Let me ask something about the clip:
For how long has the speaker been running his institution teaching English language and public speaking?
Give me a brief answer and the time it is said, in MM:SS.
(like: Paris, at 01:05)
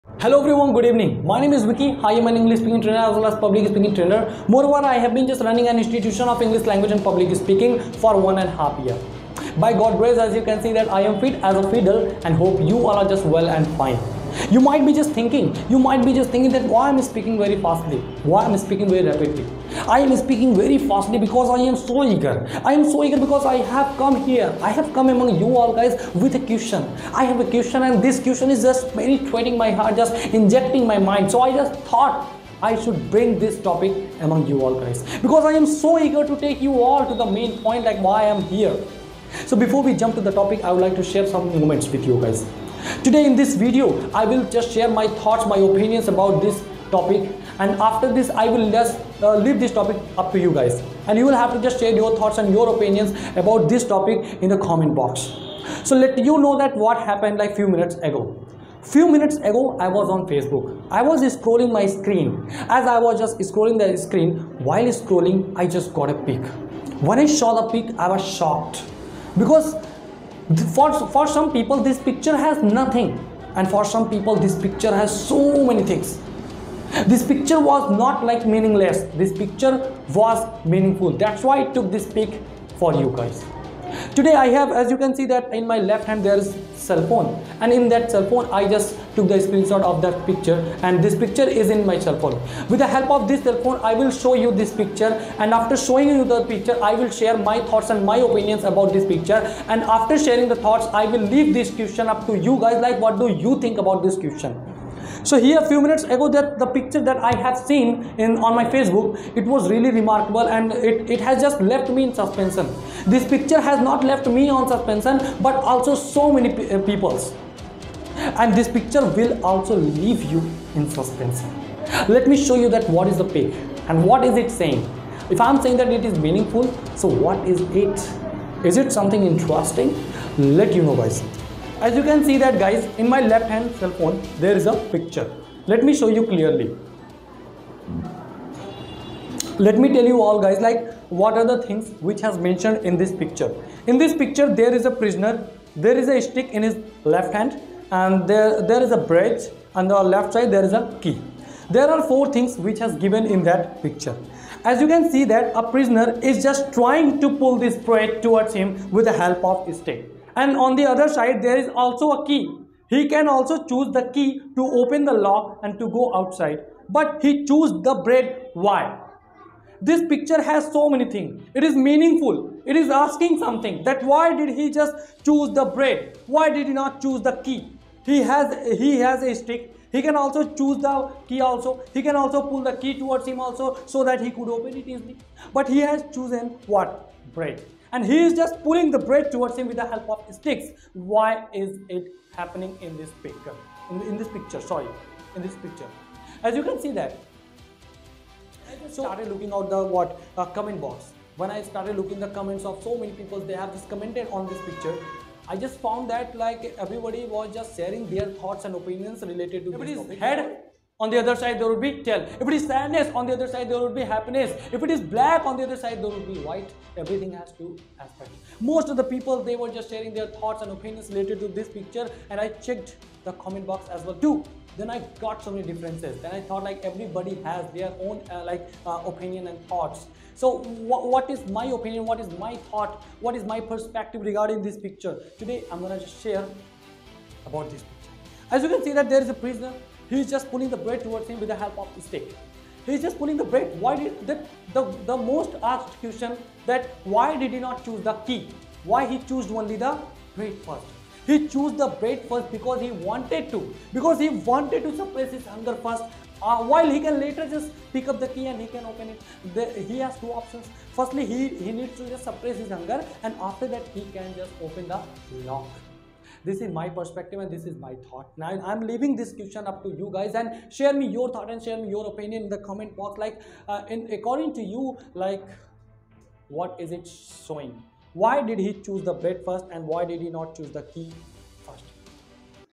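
1.5 years, at 00:08.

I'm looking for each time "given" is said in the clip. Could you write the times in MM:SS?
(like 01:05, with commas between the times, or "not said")
02:32.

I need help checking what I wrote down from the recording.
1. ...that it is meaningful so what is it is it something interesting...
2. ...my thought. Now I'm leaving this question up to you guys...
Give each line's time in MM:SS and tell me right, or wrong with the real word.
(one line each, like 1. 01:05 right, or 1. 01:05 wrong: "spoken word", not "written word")
1. 02:05 right
2. 04:27 right.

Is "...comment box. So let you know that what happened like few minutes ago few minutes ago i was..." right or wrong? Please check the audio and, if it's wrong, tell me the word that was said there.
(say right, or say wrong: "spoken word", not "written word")
right.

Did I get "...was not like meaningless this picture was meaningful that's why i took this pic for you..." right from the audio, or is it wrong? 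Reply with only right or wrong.
right.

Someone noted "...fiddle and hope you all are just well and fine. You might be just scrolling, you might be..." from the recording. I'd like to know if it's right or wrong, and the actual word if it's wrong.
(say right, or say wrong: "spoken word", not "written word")
wrong: "thinking", not "scrolling".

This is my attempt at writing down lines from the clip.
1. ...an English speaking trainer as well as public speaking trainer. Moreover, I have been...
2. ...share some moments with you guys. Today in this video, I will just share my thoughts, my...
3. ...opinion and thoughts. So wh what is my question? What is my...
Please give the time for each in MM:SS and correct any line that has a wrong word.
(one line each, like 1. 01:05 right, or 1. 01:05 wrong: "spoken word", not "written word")
1. 00:02 right
2. 00:41 right
3. 03:49 wrong: "opinion", not "question".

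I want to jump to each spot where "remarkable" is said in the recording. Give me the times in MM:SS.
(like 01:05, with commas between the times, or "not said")
01:49.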